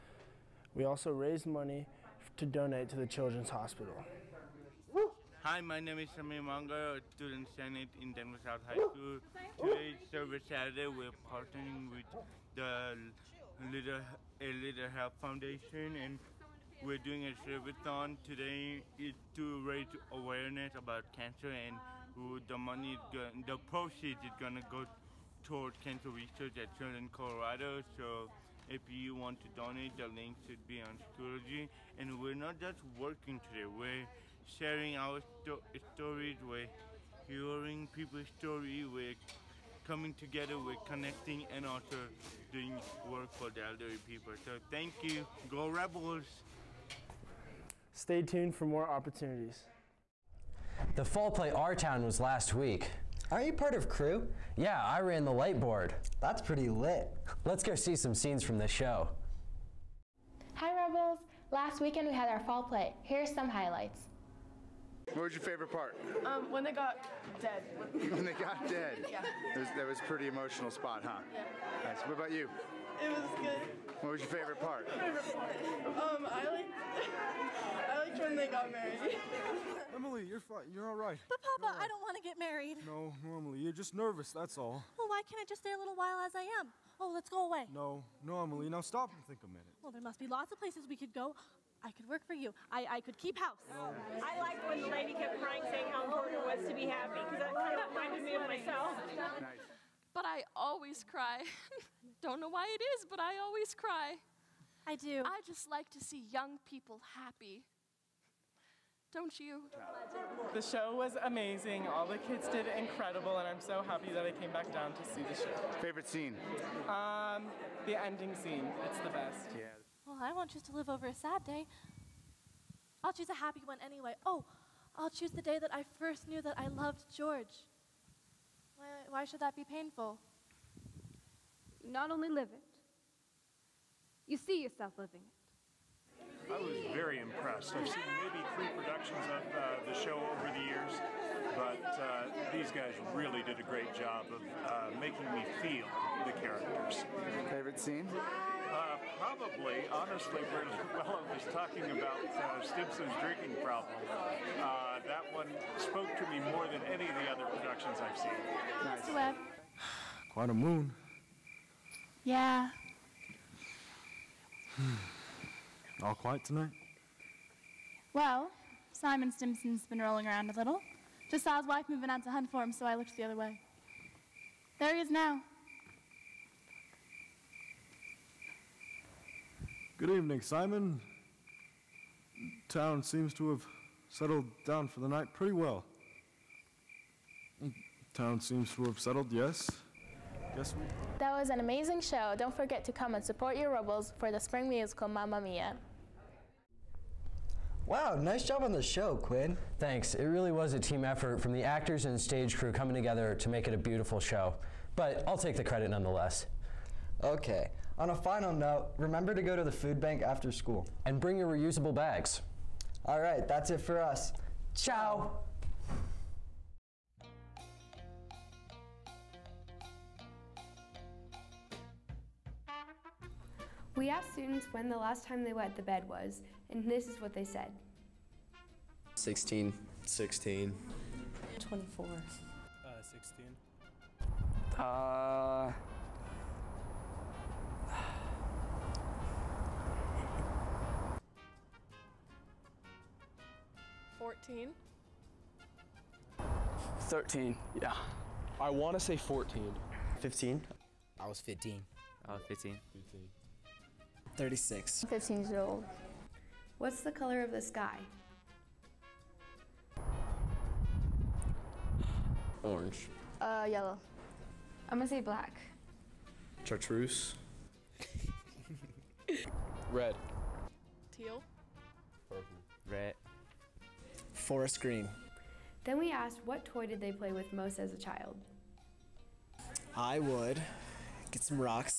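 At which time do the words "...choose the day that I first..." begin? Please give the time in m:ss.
2:05.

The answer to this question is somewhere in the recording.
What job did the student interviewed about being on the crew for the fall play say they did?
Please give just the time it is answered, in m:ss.
0:54.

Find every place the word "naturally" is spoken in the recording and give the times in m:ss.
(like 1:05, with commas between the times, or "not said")
not said.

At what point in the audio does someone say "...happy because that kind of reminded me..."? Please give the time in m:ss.
1:36.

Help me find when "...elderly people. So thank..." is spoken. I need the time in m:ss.
0:43.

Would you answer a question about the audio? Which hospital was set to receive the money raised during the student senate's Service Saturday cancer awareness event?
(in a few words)
Children's Hospital.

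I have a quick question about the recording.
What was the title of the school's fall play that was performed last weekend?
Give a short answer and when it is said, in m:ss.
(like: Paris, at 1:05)
Our Town, at 0:51.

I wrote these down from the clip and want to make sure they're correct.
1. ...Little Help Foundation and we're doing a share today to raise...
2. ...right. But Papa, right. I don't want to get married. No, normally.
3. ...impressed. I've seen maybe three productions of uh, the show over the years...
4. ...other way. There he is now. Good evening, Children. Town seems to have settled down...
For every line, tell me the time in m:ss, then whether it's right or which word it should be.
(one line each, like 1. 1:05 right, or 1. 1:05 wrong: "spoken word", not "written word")
1. 0:14 right
2. 1:20 right
3. 2:17 right
4. 2:53 wrong: "Simon", not "Children".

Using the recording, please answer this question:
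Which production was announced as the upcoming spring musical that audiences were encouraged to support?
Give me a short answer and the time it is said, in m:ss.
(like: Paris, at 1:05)
Mamma Mia, at 3:15.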